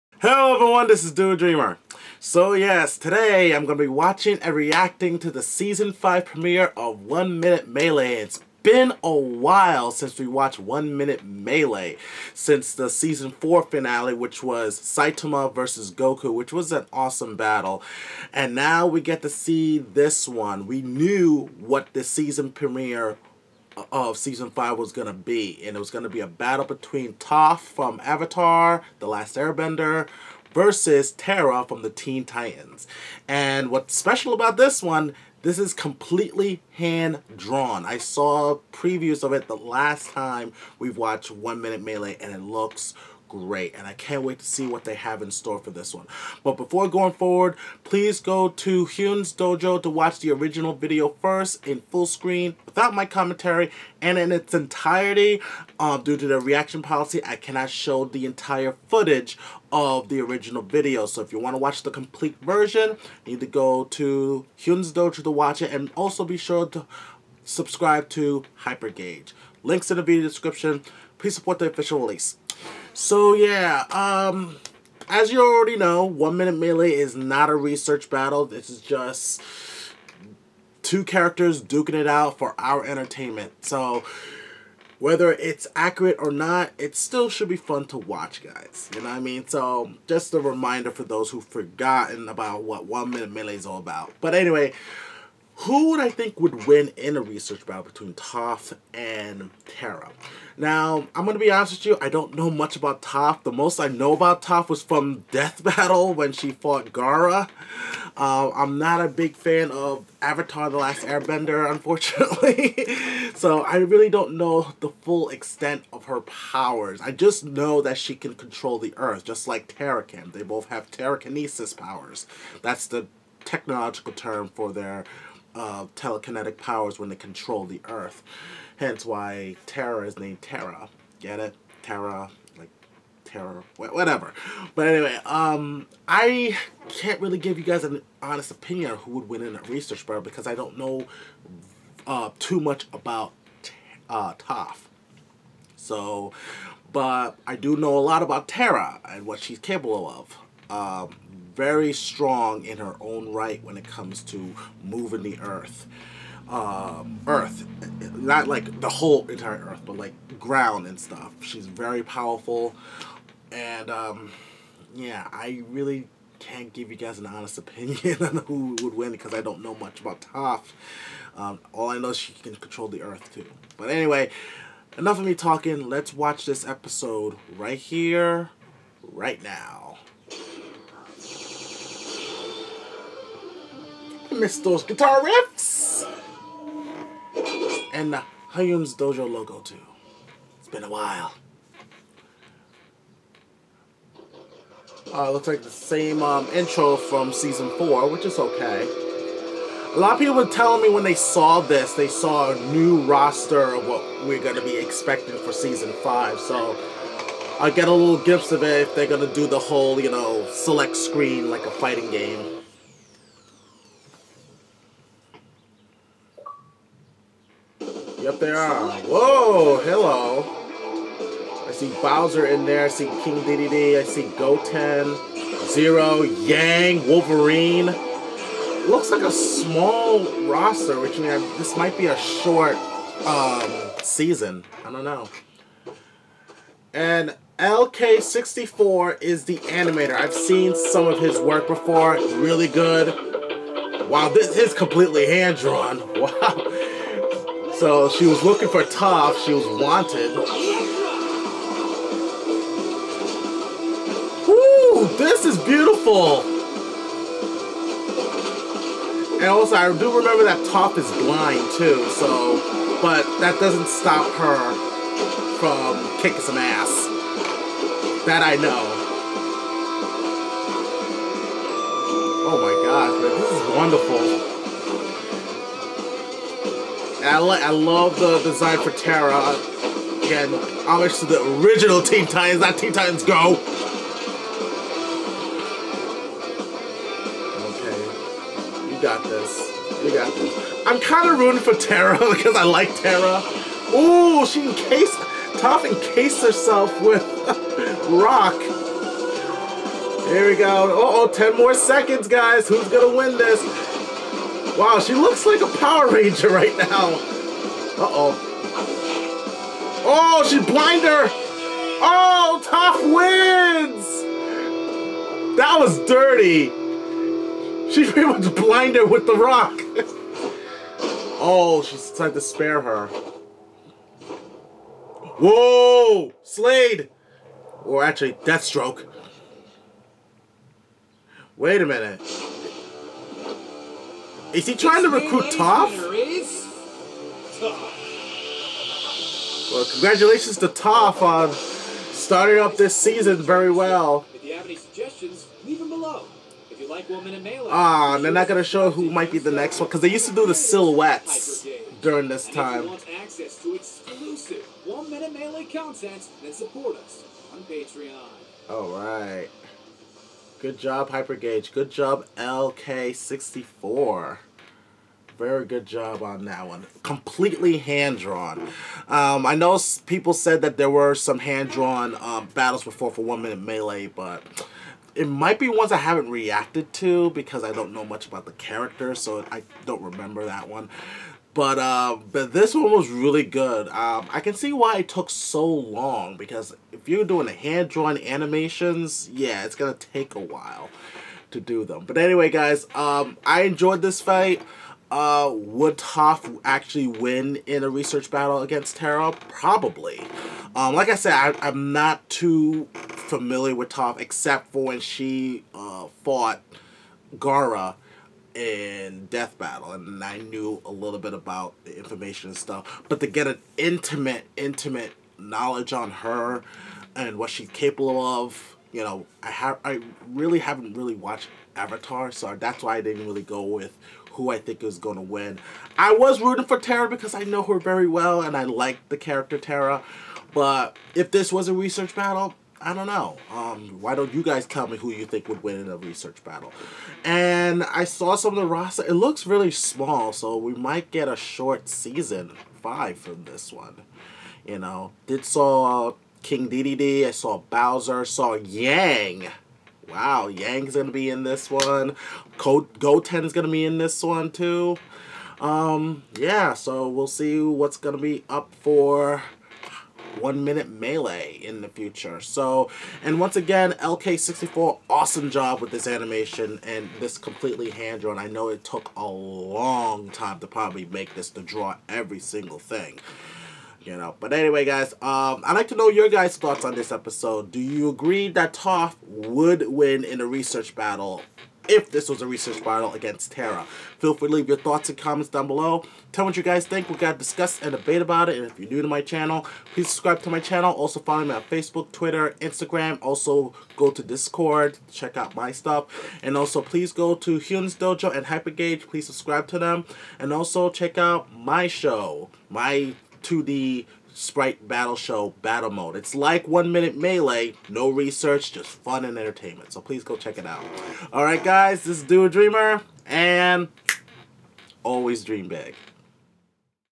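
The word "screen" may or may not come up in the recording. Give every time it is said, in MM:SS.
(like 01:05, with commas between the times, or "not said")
00:52, 03:30.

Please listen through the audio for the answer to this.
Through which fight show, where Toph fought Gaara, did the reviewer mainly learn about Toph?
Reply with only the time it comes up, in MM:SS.
01:45.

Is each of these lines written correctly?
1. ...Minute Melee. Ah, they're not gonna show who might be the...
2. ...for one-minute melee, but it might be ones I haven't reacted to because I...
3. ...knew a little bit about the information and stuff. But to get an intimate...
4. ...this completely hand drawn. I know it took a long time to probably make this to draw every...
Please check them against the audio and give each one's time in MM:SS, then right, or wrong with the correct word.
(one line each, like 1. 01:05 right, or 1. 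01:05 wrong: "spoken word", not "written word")
1. 05:47 right
2. 06:13 right
3. 06:50 right
4. 07:47 right.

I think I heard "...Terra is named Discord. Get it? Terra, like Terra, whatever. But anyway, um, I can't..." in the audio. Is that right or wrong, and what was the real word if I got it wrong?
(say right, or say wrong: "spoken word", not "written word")
wrong: "Terra", not "Discord".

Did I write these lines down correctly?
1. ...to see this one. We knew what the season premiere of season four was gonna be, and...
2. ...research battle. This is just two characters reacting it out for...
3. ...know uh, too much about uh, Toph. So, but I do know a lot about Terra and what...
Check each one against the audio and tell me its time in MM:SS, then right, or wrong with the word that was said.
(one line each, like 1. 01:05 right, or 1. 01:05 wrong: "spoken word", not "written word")
1. 00:19 wrong: "five", not "four"
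2. 01:17 wrong: "duking", not "reacting"
3. 02:20 right.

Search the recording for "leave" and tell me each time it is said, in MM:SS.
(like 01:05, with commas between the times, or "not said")
05:45, 08:04.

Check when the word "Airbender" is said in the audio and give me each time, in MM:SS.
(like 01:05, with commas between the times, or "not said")
00:29, 01:51.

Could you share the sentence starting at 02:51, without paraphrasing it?
Um, all I know is she can control the earth too.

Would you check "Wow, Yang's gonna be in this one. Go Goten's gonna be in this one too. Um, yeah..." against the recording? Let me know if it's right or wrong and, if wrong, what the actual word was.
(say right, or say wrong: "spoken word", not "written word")
right.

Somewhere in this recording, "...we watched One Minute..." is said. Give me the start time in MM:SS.
00:10.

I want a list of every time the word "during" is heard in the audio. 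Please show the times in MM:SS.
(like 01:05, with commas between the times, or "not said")
05:52.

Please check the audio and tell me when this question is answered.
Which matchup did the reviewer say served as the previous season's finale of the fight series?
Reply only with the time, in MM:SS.
00:14.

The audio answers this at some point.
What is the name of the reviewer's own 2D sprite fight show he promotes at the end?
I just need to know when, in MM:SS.
08:25.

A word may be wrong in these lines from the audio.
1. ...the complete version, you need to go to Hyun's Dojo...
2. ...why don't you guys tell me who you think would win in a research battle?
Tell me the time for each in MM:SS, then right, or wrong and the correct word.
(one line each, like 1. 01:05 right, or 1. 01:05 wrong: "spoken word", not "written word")
1. 01:01 right
2. 07:14 right.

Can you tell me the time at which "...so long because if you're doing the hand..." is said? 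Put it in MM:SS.
06:25.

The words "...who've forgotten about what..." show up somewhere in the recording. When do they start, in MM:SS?
01:31.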